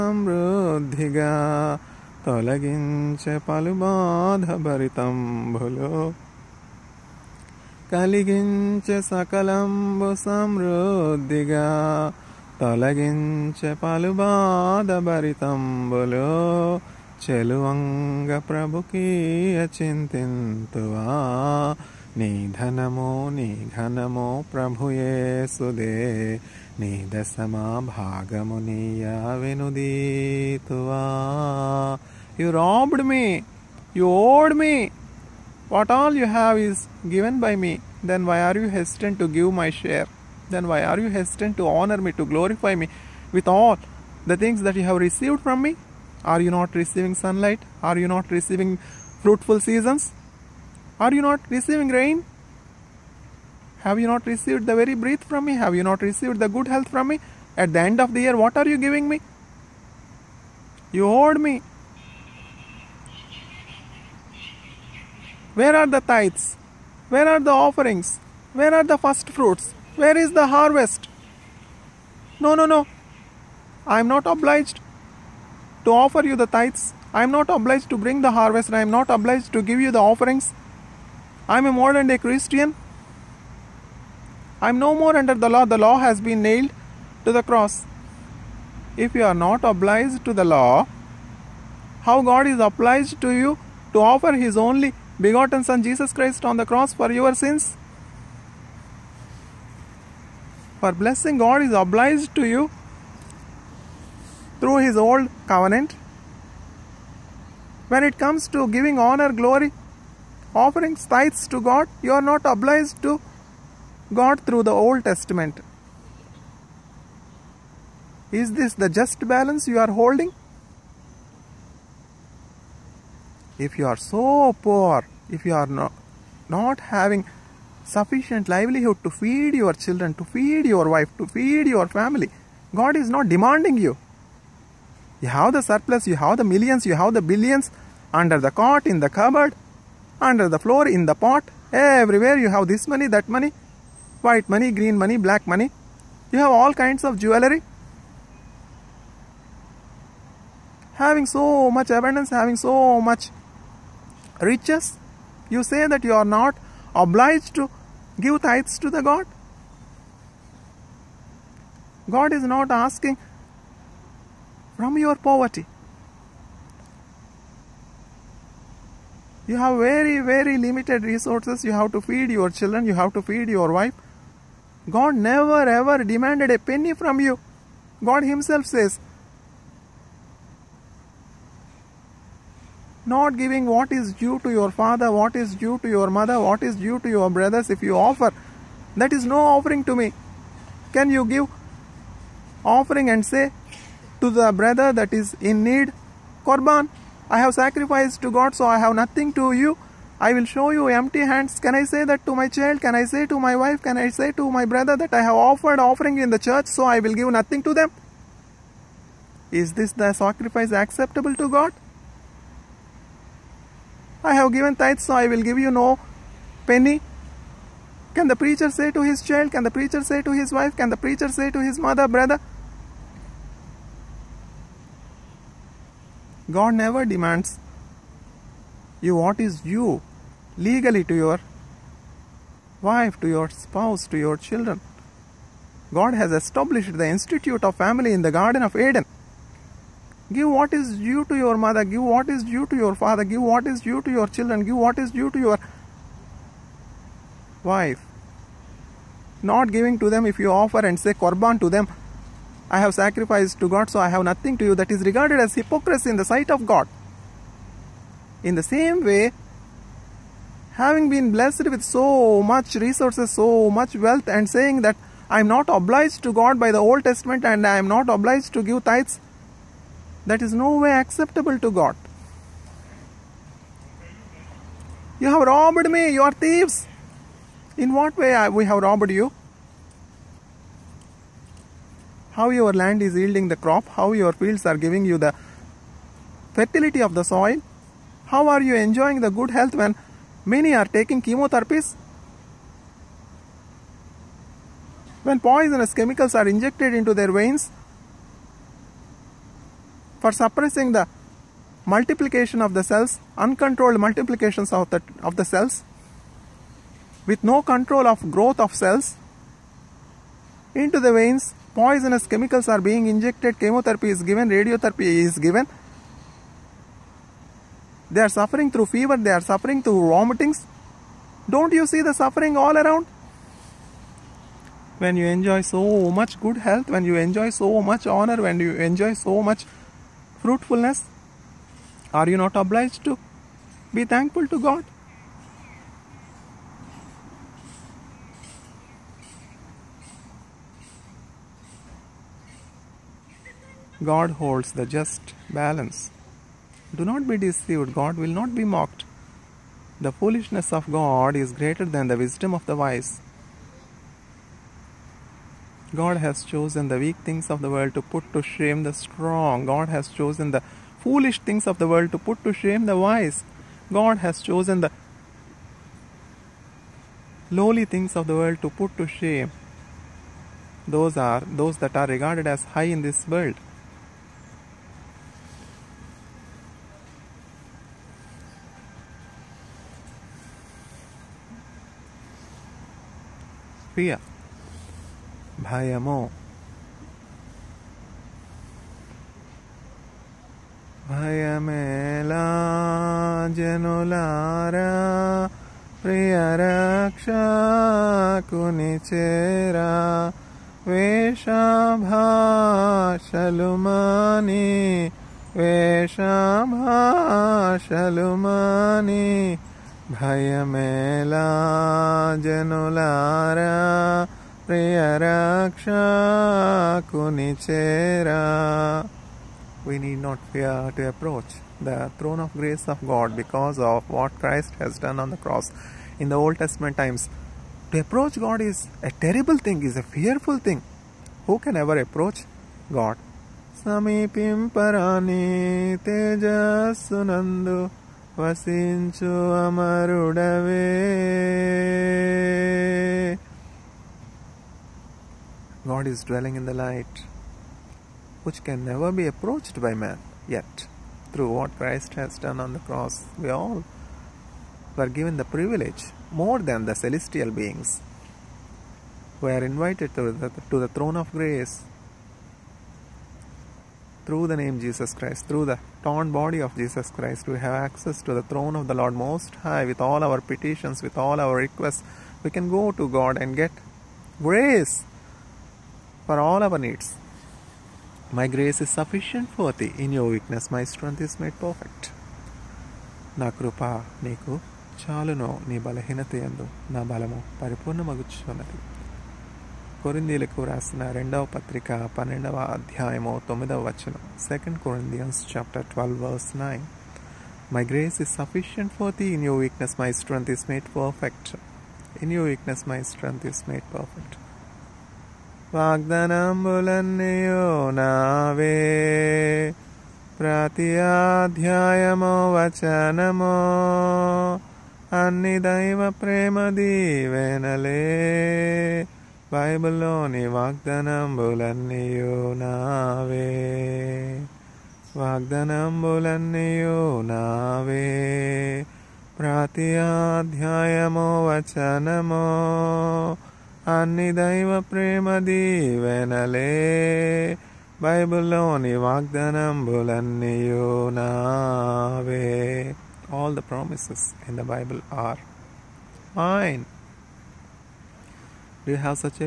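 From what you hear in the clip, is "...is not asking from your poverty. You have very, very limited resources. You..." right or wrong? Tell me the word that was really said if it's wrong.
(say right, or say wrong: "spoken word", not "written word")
right.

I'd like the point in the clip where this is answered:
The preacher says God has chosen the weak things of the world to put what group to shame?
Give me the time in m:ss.
5:58.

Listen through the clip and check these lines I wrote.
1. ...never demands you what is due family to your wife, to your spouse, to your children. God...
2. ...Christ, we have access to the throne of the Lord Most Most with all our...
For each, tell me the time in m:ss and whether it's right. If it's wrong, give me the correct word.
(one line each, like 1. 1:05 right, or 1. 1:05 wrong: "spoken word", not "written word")
1. 3:46 wrong: "legally", not "family"
2. 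7:47 wrong: "High", not "Most".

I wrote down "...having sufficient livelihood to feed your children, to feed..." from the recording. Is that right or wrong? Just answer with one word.
right.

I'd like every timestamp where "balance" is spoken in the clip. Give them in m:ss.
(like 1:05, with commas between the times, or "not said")
1:59, 5:45.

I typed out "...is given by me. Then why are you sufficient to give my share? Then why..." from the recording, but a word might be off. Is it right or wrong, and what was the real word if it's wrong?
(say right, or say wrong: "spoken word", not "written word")
wrong: "hesitant", not "sufficient".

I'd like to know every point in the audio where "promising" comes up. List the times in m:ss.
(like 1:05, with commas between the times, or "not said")
not said.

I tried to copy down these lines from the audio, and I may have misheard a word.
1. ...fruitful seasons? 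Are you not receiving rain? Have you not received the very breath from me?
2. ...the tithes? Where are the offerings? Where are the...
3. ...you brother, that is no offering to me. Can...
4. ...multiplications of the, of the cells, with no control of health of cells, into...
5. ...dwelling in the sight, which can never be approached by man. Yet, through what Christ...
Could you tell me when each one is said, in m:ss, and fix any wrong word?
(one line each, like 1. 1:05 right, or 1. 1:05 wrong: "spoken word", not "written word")
1. 0:49 right
2. 1:05 right
3. 3:07 wrong: "offer", not "brother"
4. 5:03 wrong: "growth", not "health"
5. 7:26 wrong: "light", not "sight".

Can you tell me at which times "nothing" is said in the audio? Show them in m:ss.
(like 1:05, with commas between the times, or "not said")
3:18, 3:27, 4:14.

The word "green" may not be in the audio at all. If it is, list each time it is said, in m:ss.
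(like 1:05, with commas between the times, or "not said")
2:24.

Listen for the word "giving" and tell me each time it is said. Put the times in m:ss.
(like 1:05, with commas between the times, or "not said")
0:58, 1:48, 3:03, 4:09, 4:44.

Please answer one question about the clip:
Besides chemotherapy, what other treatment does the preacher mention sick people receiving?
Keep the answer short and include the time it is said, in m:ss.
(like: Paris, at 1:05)
radiotherapy, at 5:14.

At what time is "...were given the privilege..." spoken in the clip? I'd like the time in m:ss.
7:34.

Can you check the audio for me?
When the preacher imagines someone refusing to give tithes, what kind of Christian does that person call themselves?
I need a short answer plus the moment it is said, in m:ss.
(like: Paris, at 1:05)
modern day Christian, at 1:21.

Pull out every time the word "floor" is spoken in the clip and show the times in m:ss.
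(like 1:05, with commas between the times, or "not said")
2:20.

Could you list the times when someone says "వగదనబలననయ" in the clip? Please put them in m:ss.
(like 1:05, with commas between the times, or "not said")
8:25, 8:40, 8:45, 8:59.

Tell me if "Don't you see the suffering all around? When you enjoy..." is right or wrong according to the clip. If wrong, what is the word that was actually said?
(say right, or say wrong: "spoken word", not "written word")
right.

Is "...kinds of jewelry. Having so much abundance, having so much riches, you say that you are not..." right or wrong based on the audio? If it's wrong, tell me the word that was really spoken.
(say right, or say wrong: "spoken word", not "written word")
right.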